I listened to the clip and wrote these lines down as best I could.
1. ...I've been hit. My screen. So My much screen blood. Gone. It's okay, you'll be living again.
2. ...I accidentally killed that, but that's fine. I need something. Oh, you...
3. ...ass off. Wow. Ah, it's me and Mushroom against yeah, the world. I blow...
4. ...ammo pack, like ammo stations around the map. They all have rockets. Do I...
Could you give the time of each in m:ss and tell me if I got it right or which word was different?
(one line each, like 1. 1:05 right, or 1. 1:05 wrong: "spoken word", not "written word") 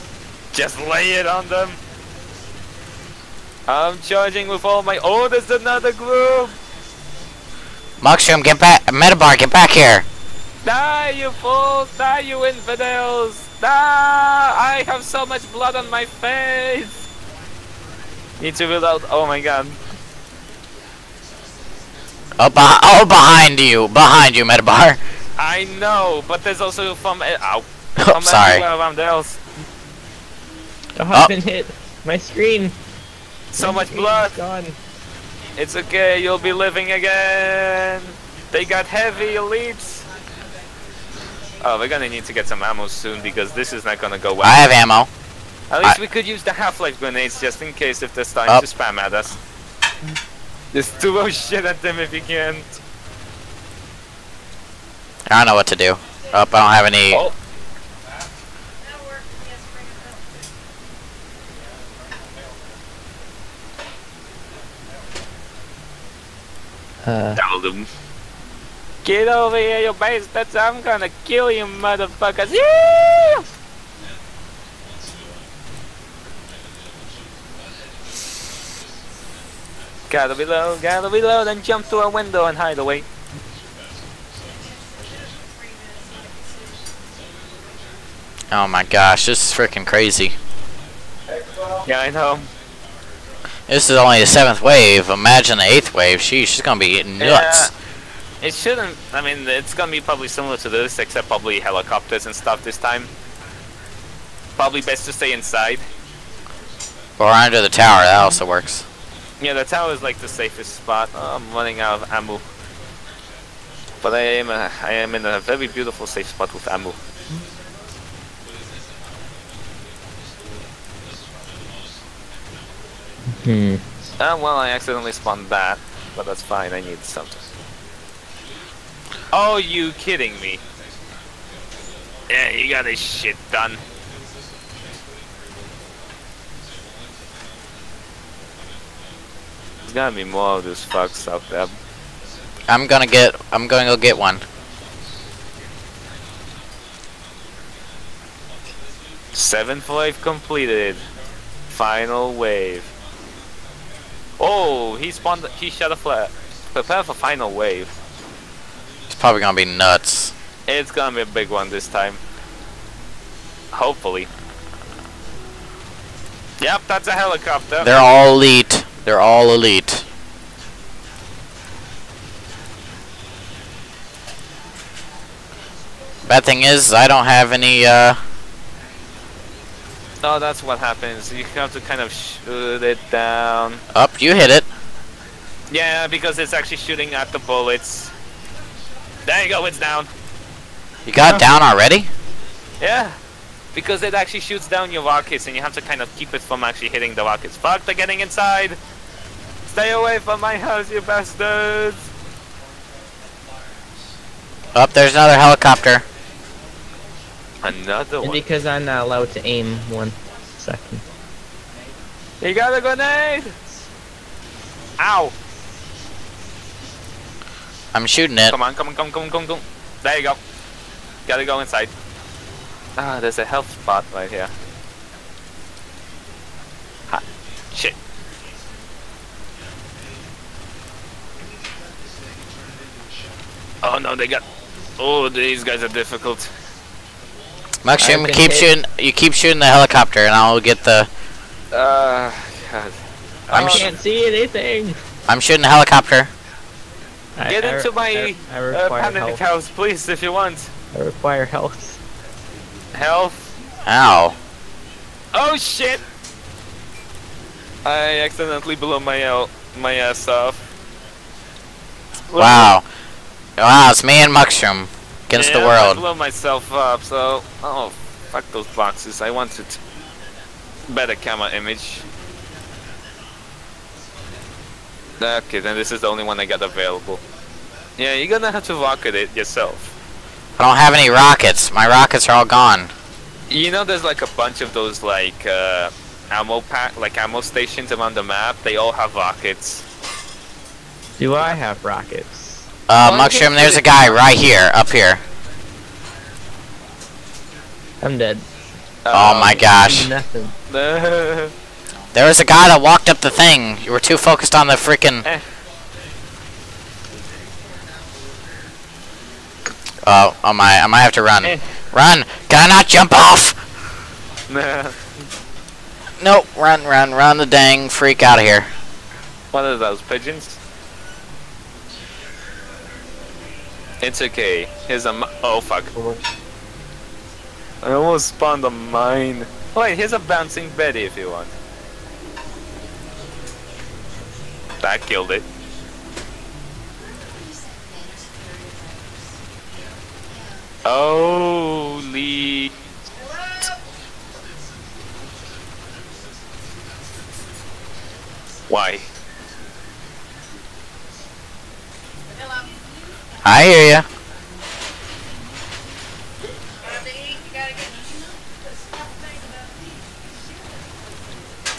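1. 0:31 right
2. 2:04 wrong: "spawned", not "killed"
3. 4:19 right
4. 4:46 right.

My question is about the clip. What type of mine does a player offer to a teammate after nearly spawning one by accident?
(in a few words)
bouncing Betty.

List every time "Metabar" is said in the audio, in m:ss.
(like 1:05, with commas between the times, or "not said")
0:08, 0:24.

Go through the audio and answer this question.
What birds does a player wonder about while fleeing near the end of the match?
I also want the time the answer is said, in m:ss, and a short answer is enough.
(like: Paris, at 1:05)
pigeons, at 5:20.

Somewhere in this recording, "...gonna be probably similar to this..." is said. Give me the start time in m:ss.
1:39.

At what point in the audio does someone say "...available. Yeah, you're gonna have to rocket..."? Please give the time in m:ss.
4:36.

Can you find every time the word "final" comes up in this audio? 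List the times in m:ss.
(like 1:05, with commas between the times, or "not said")
2:31, 2:37.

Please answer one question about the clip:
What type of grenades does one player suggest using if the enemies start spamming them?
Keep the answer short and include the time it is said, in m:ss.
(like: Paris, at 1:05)
Half-Life grenades, at 0:46.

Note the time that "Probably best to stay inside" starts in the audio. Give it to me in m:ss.
1:44.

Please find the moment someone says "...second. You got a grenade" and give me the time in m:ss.
3:30.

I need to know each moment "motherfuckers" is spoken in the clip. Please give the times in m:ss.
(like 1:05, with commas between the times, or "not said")
1:11.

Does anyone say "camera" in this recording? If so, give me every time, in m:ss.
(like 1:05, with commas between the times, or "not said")
4:31.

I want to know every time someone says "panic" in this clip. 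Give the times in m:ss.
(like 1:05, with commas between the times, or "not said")
4:09.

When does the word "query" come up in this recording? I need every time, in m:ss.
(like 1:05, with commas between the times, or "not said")
not said.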